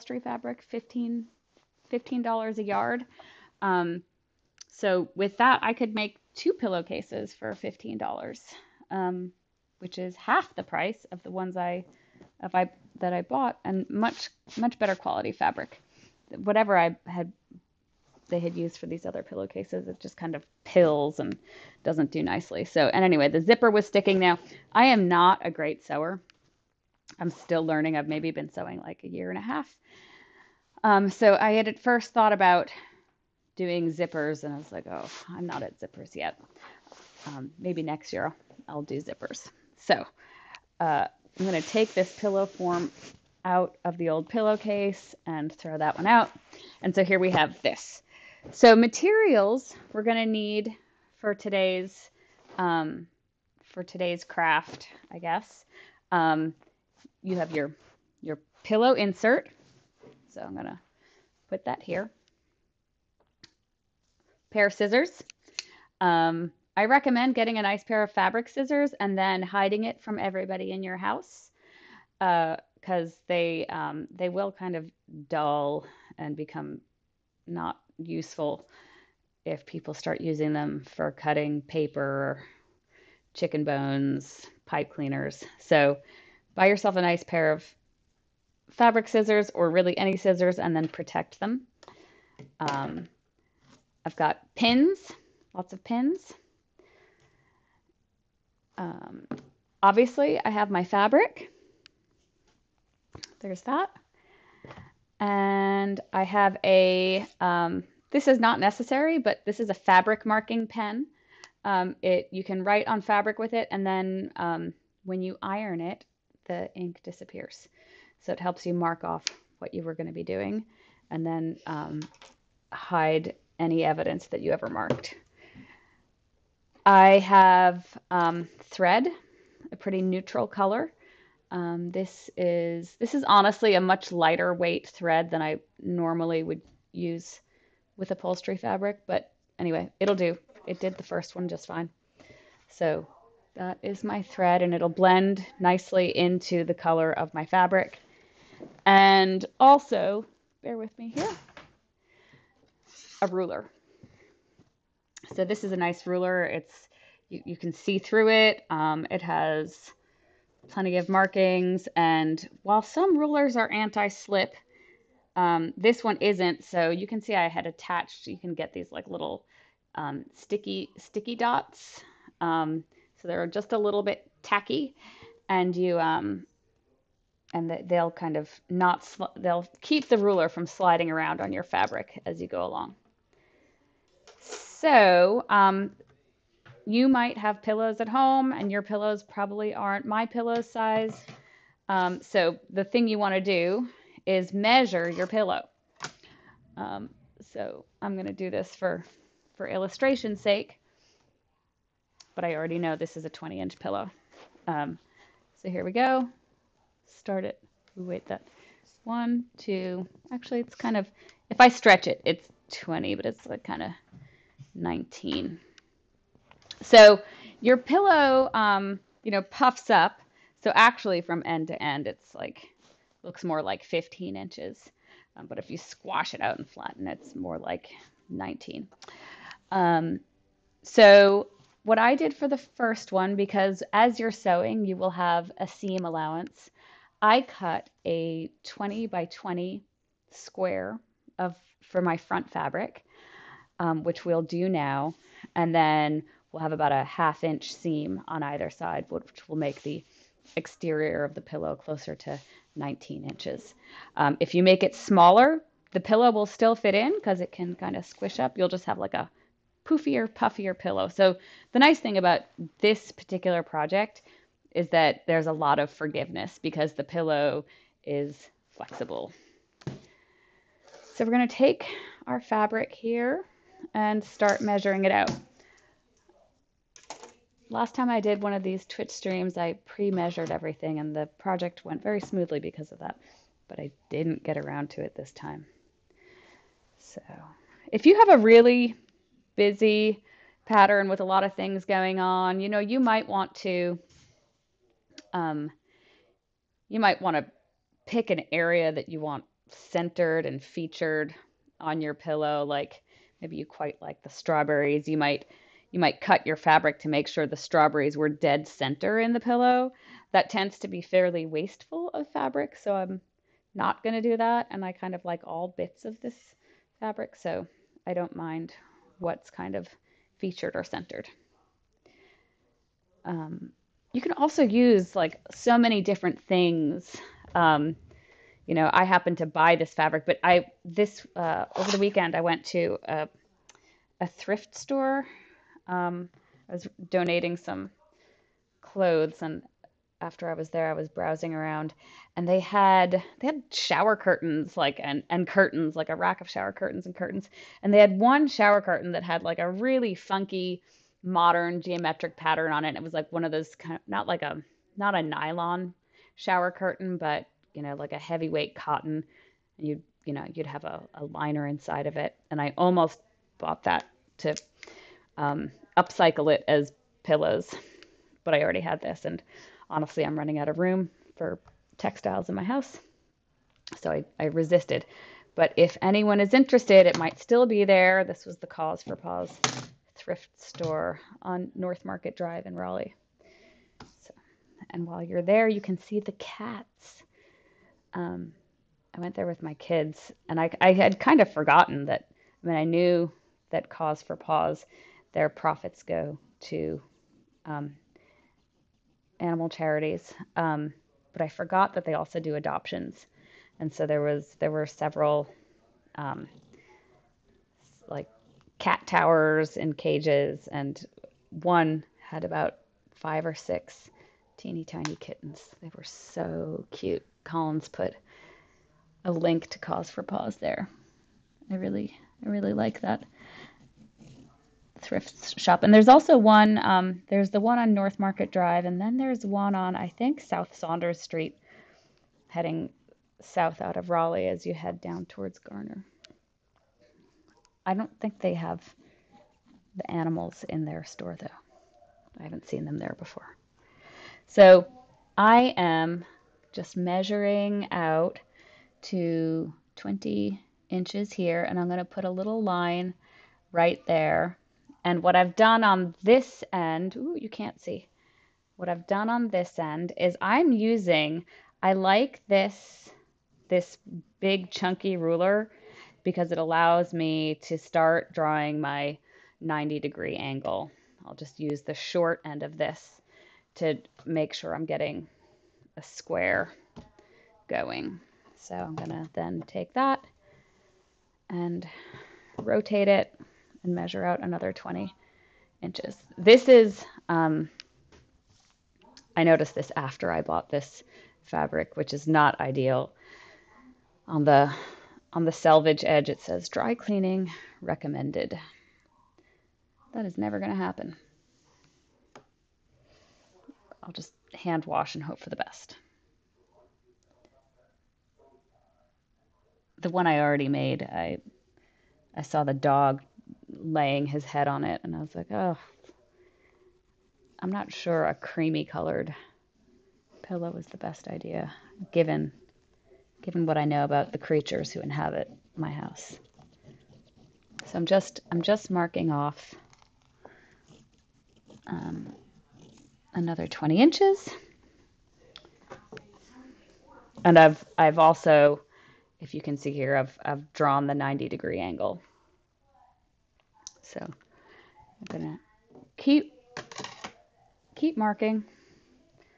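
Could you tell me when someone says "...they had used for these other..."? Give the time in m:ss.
0:18.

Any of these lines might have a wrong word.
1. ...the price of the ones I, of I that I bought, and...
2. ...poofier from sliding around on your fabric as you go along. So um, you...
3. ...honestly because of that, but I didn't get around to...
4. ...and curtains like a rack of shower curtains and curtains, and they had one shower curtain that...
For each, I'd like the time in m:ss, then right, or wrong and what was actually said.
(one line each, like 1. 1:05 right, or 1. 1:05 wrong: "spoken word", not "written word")
1. 0:10 right
2. 3:00 wrong: "ruler", not "poofier"
3. 4:42 wrong: "smoothly", not "honestly"
4. 5:45 right.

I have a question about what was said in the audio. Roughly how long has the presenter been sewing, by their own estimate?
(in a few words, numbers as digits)
a year and a half.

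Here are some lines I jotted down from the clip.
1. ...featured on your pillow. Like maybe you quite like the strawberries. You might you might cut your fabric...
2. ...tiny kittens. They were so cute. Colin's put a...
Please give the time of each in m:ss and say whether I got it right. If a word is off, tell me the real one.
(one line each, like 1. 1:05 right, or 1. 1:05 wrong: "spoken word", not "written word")
1. 5:00 right
2. 6:54 right.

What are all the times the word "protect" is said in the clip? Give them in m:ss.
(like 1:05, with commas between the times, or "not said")
1:30.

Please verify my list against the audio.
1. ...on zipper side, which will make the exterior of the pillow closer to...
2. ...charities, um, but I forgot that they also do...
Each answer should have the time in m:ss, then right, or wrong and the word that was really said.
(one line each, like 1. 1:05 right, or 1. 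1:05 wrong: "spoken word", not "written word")
1. 4:08 wrong: "either", not "zipper"
2. 6:39 right.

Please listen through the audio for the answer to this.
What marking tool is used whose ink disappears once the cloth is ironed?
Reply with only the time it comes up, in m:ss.
1:49.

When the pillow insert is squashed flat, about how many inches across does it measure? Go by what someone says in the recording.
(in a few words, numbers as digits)
19.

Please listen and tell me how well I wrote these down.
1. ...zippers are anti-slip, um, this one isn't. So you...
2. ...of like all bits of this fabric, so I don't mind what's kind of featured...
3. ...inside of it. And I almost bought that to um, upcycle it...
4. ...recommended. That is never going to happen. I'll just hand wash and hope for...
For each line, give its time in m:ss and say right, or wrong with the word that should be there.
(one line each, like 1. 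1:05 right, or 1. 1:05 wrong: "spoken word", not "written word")
1. 2:43 wrong: "rulers", not "zippers"
2. 5:15 right
3. 6:01 right
4. 8:17 right.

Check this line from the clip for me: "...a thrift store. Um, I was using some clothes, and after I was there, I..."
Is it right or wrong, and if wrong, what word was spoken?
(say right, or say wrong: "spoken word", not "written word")
wrong: "donating", not "using".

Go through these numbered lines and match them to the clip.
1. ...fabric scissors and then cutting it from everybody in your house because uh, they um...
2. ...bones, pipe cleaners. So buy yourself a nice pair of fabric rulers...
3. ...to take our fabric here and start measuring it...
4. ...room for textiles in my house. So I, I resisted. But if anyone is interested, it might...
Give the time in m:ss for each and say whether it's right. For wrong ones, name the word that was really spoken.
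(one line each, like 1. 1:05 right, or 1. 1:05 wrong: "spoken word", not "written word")
1. 1:08 wrong: "hiding", not "cutting"
2. 1:23 wrong: "scissors", not "rulers"
3. 4:31 right
4. 6:10 right.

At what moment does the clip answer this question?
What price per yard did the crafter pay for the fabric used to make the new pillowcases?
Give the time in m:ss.
0:00.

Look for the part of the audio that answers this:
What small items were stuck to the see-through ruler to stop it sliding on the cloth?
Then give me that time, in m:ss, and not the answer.
2:50.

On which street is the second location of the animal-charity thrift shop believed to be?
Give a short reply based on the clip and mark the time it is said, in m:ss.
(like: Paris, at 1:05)
South Saunders Street, at 7:10.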